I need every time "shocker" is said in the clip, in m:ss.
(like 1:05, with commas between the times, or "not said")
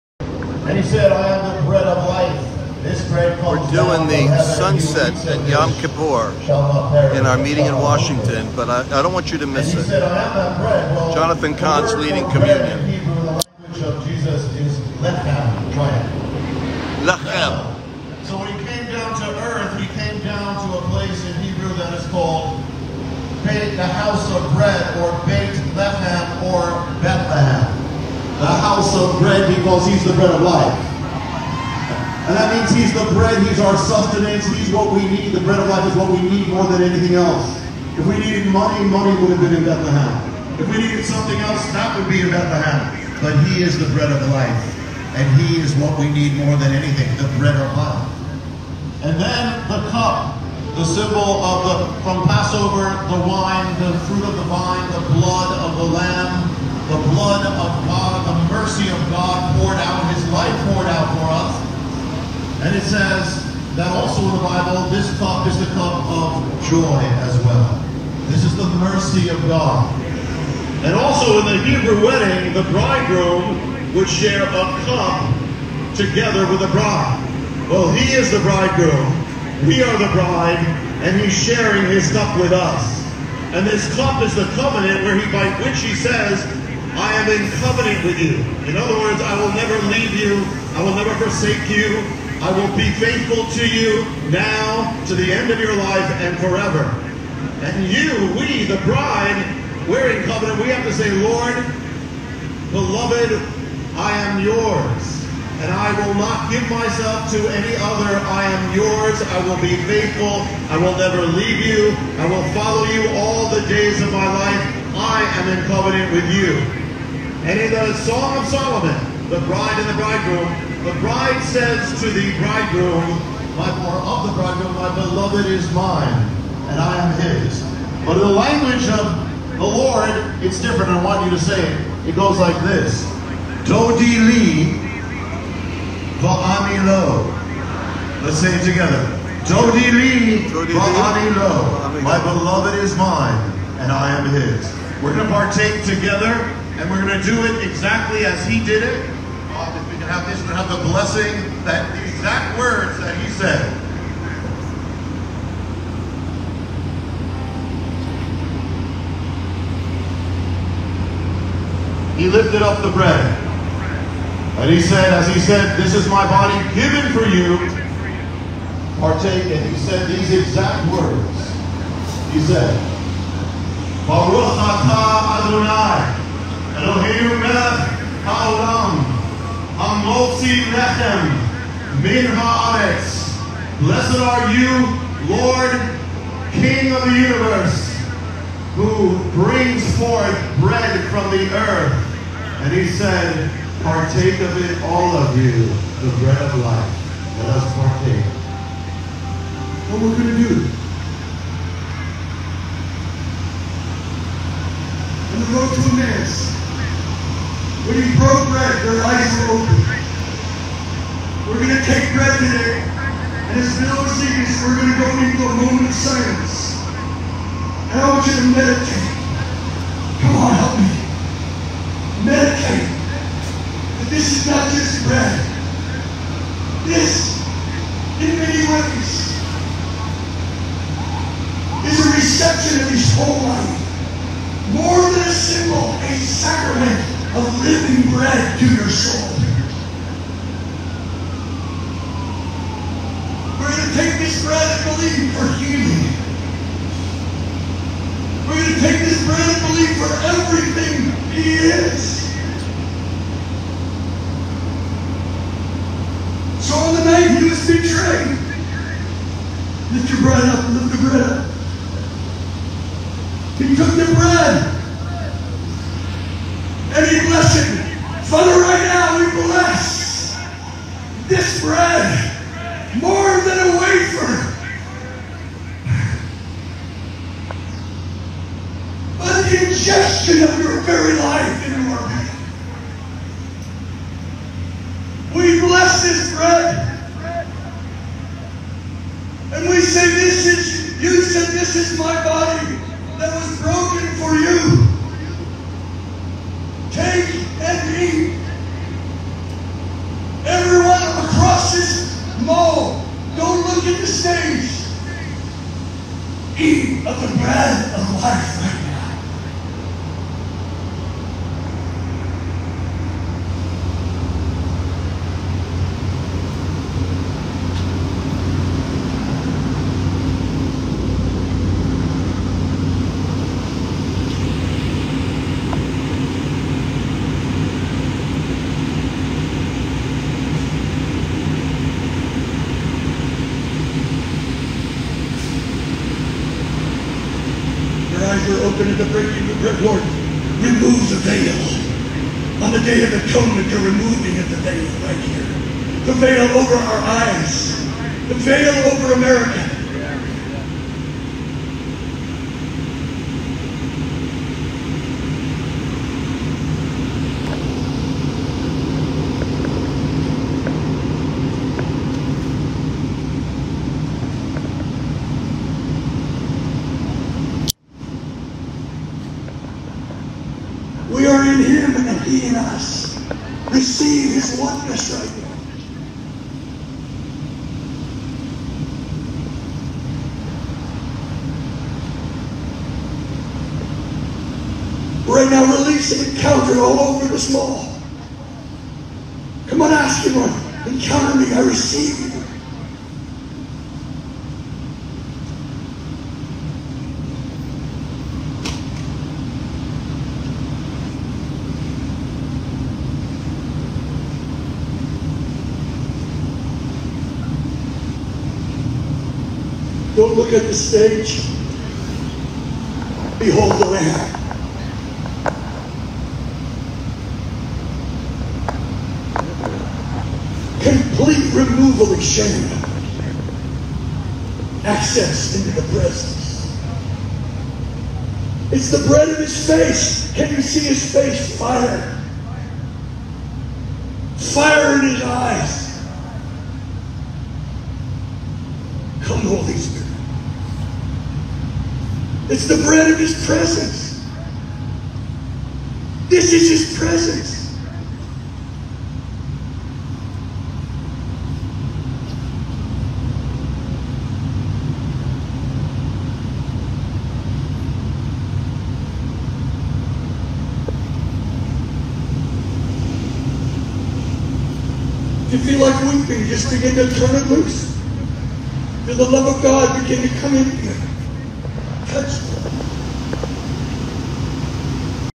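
not said.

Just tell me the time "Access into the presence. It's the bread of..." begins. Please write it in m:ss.
7:04.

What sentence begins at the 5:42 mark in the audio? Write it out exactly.
On the day of atonement, you're removing of the veil right here.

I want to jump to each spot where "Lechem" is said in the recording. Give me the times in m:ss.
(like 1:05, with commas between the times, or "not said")
0:17, 0:25, 3:00.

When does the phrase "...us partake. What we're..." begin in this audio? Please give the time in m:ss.
3:17.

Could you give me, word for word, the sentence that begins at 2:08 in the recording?
But in the language of the Lord, it's different.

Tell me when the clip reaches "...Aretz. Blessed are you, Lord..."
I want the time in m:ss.
3:02.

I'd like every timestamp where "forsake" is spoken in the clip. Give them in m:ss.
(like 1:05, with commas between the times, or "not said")
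1:31.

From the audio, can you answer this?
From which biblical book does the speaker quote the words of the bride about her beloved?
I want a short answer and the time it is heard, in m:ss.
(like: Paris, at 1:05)
Song of Solomon, at 1:58.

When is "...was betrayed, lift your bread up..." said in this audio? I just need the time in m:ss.
4:17.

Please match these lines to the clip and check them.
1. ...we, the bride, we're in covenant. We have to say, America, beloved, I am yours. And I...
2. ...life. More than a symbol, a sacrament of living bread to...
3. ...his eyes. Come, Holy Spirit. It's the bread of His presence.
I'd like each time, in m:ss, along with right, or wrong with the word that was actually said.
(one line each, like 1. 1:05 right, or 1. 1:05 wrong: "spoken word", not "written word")
1. 1:38 wrong: "Lord", not "America"
2. 3:53 right
3. 7:15 right.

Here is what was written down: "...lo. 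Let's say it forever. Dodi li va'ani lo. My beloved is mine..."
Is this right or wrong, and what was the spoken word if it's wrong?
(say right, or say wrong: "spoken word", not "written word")
wrong: "together", not "forever".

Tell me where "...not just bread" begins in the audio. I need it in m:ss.
3:44.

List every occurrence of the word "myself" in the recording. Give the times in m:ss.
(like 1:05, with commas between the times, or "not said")
1:46.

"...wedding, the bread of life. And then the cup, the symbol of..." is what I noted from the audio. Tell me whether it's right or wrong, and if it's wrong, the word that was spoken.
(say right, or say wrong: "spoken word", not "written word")
wrong: "anything", not "wedding".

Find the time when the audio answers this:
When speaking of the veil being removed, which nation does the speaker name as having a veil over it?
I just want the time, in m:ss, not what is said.
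5:49.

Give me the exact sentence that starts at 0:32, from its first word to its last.
And that means he's the bread, he's our sustenance, he's what we need.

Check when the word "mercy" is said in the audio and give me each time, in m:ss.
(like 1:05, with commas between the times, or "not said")
0:58, 1:08.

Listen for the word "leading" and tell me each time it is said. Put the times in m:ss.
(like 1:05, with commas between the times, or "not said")
0:11.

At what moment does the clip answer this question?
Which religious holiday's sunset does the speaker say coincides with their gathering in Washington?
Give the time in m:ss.
0:05.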